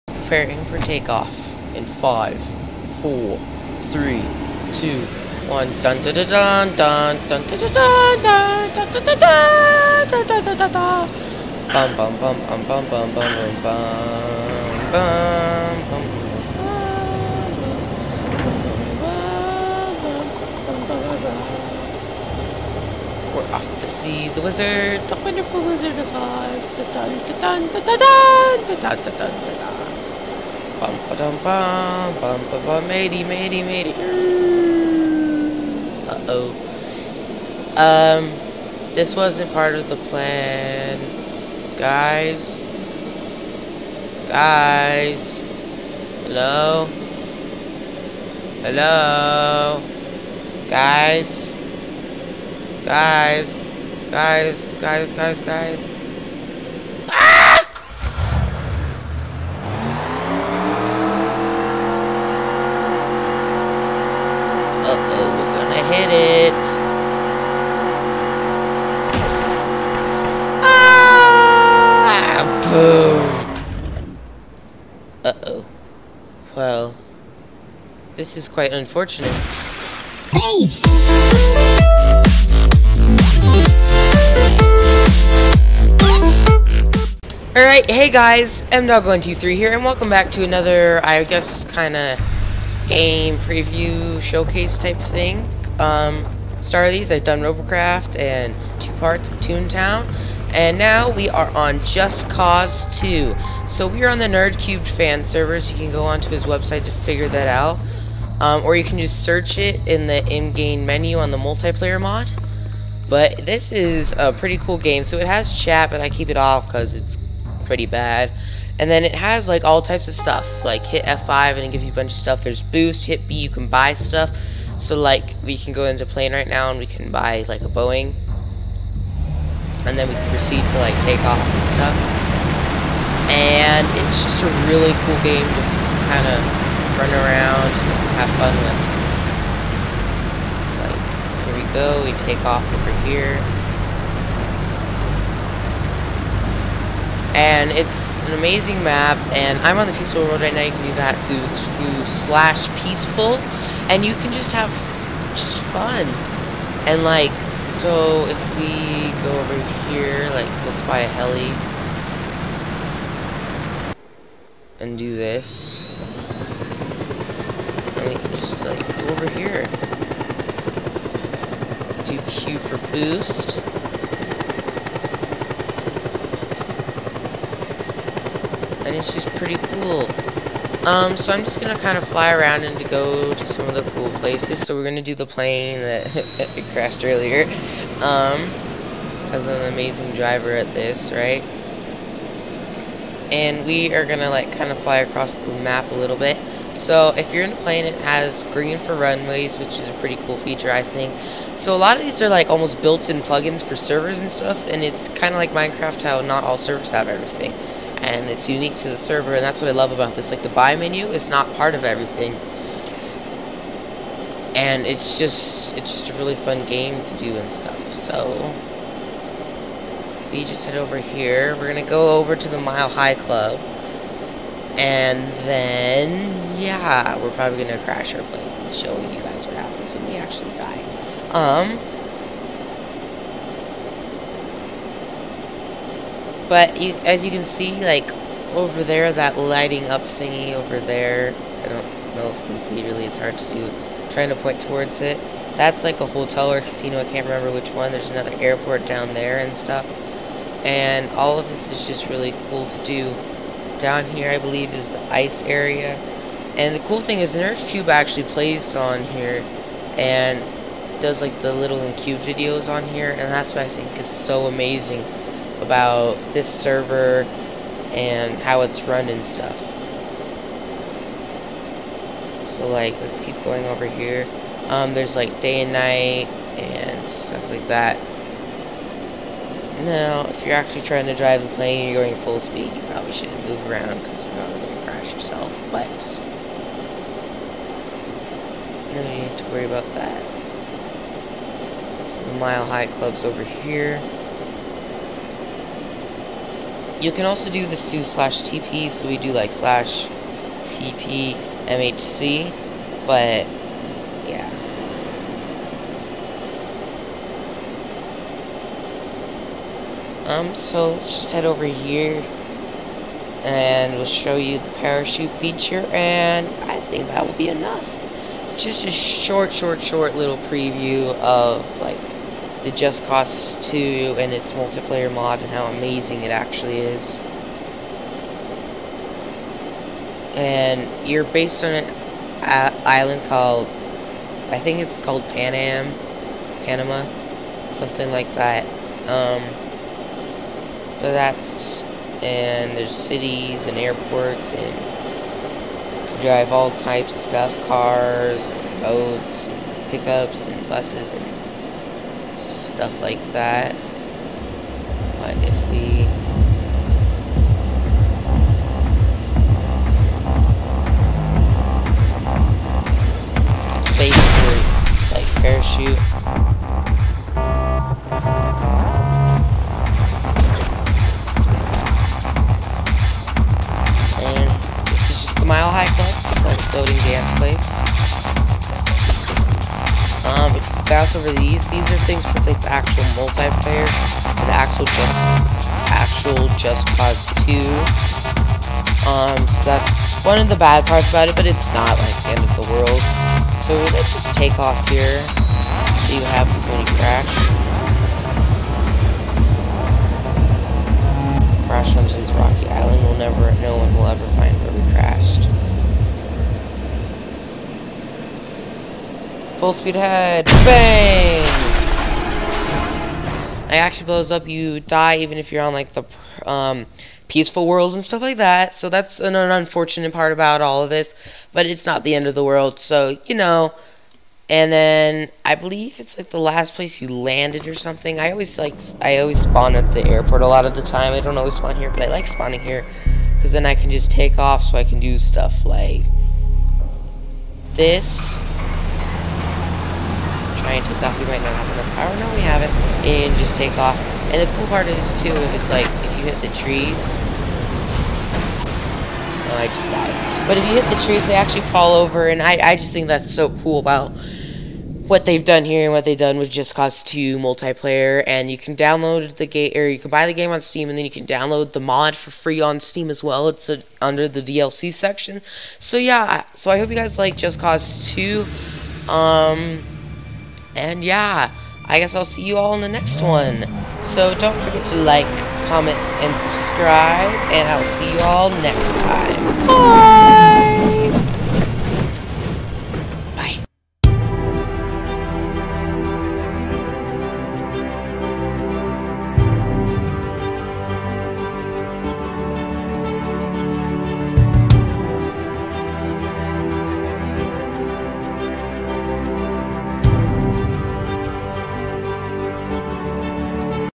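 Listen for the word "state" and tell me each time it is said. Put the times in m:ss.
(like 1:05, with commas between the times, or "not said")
not said.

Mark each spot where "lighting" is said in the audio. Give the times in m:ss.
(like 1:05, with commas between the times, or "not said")
3:59.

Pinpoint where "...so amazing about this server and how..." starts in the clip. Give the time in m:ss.
4:24.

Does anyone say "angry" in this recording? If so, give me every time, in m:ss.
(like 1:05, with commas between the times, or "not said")
not said.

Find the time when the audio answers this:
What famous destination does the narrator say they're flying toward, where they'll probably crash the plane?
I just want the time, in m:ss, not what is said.
3:42.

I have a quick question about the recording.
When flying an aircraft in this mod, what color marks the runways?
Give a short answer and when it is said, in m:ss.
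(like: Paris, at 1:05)
Green, at 3:18.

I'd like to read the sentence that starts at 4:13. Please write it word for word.
Down here, I believe, is the ice area.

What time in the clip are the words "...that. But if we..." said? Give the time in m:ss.
5:53.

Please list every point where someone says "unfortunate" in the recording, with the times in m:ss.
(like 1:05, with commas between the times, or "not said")
1:18, 6:59.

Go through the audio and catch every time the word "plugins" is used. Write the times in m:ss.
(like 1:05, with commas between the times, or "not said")
3:23.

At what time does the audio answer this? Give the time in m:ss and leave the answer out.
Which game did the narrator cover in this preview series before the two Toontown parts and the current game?
1:37.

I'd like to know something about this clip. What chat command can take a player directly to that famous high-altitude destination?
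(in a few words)
/tp MHC.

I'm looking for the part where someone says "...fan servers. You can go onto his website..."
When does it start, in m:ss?
1:44.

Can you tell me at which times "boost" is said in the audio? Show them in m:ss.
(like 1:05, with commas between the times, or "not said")
2:02, 2:52.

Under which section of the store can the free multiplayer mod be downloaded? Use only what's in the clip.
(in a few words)
DLC section.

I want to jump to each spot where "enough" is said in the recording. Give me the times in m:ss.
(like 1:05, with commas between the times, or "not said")
5:17, 7:21.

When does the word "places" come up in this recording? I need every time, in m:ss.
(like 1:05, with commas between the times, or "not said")
3:04, 7:06.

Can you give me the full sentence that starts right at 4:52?
Some mile high clubs over here.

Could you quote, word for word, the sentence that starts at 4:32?
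So like, let's keep going over here.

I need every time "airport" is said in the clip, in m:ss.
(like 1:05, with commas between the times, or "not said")
4:08, 5:43, 7:10.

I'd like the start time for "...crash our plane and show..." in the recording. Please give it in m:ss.
3:47.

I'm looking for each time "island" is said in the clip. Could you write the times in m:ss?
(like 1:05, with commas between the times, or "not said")
5:32, 6:42.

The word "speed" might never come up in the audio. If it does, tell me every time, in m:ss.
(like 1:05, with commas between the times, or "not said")
4:42, 6:49.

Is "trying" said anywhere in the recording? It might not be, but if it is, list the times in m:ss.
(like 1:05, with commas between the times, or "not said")
4:04, 4:40.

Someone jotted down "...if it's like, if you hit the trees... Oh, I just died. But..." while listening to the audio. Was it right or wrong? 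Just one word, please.
right.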